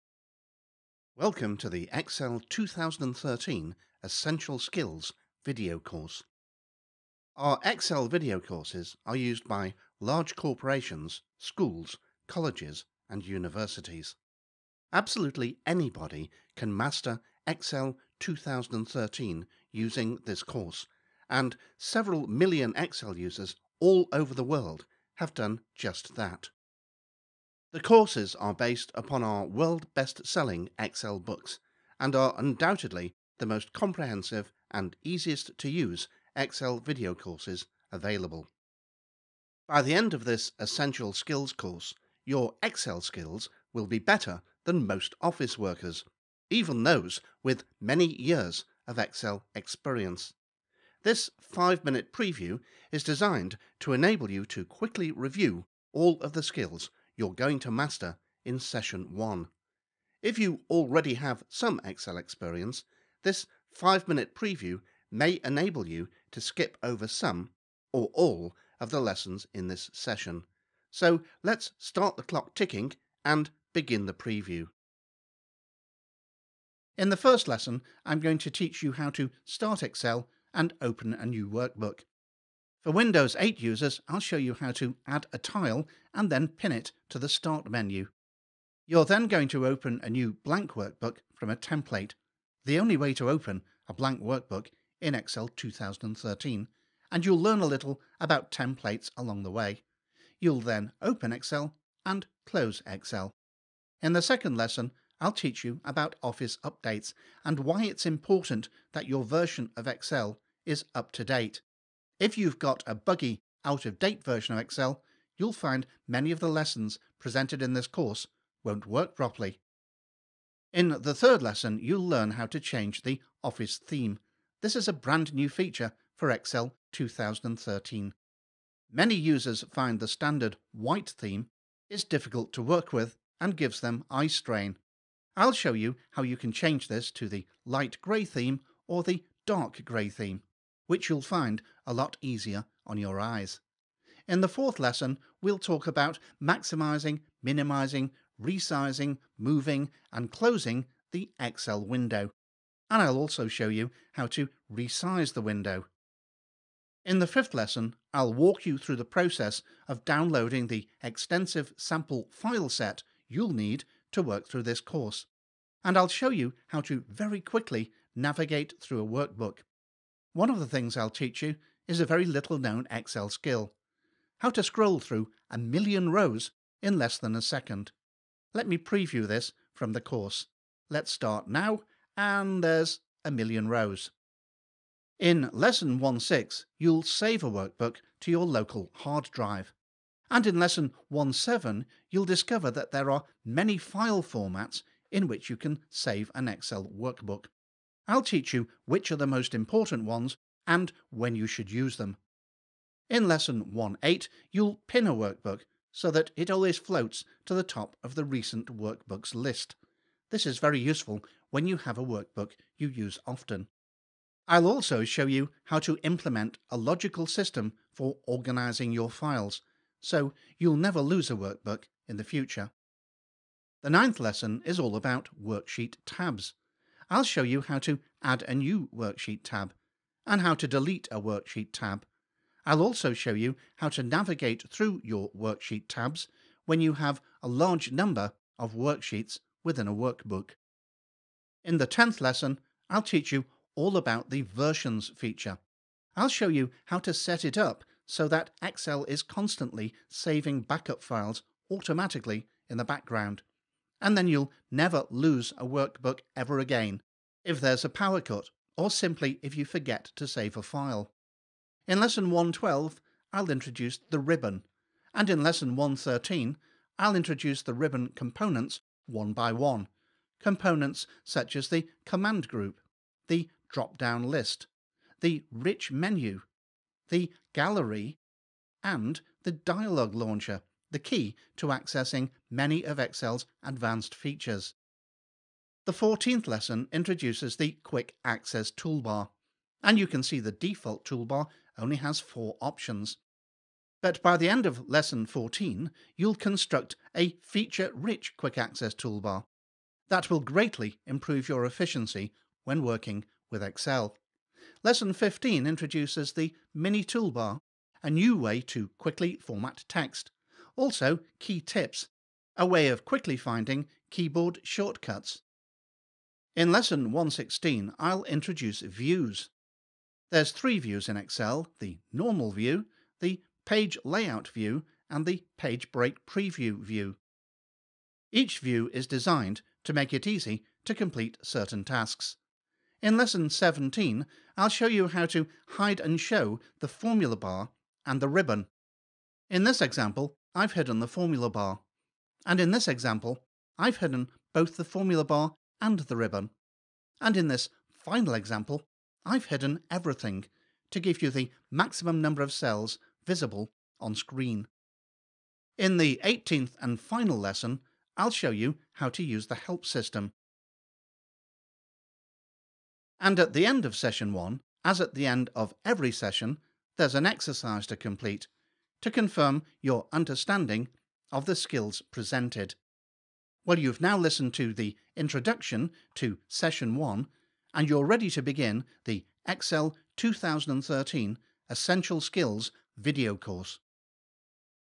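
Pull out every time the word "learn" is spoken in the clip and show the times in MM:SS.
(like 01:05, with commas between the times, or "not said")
01:37, 02:02.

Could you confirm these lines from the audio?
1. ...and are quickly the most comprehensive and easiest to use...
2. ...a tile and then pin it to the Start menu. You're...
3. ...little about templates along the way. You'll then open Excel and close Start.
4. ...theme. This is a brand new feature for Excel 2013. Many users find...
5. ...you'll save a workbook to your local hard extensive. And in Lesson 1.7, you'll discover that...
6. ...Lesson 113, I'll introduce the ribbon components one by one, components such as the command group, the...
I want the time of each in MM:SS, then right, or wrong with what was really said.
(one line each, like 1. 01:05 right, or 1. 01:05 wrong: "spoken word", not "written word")
1. 00:32 wrong: "undoubtedly", not "quickly"
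2. 01:25 right
3. 01:37 wrong: "Excel", not "Start"
4. 02:03 right
5. 03:06 wrong: "drive", not "extensive"
6. 04:25 right.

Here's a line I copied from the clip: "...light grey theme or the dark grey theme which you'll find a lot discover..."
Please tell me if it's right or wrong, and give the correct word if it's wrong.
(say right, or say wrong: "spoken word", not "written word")
wrong: "easier", not "discover".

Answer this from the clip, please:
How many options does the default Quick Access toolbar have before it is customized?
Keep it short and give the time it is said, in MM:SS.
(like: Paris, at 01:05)
4, at 04:52.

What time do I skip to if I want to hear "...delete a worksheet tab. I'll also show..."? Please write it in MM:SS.
03:50.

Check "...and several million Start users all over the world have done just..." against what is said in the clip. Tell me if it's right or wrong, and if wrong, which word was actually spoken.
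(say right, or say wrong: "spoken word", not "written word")
wrong: "Excel", not "Start".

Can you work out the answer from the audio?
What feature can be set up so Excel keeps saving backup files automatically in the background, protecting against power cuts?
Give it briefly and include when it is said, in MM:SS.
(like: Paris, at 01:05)
versions feature, at 04:04.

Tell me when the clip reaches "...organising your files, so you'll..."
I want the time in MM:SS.
03:38.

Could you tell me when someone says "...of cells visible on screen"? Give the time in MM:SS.
05:52.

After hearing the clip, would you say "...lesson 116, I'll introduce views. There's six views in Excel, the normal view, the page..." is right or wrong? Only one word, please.
wrong.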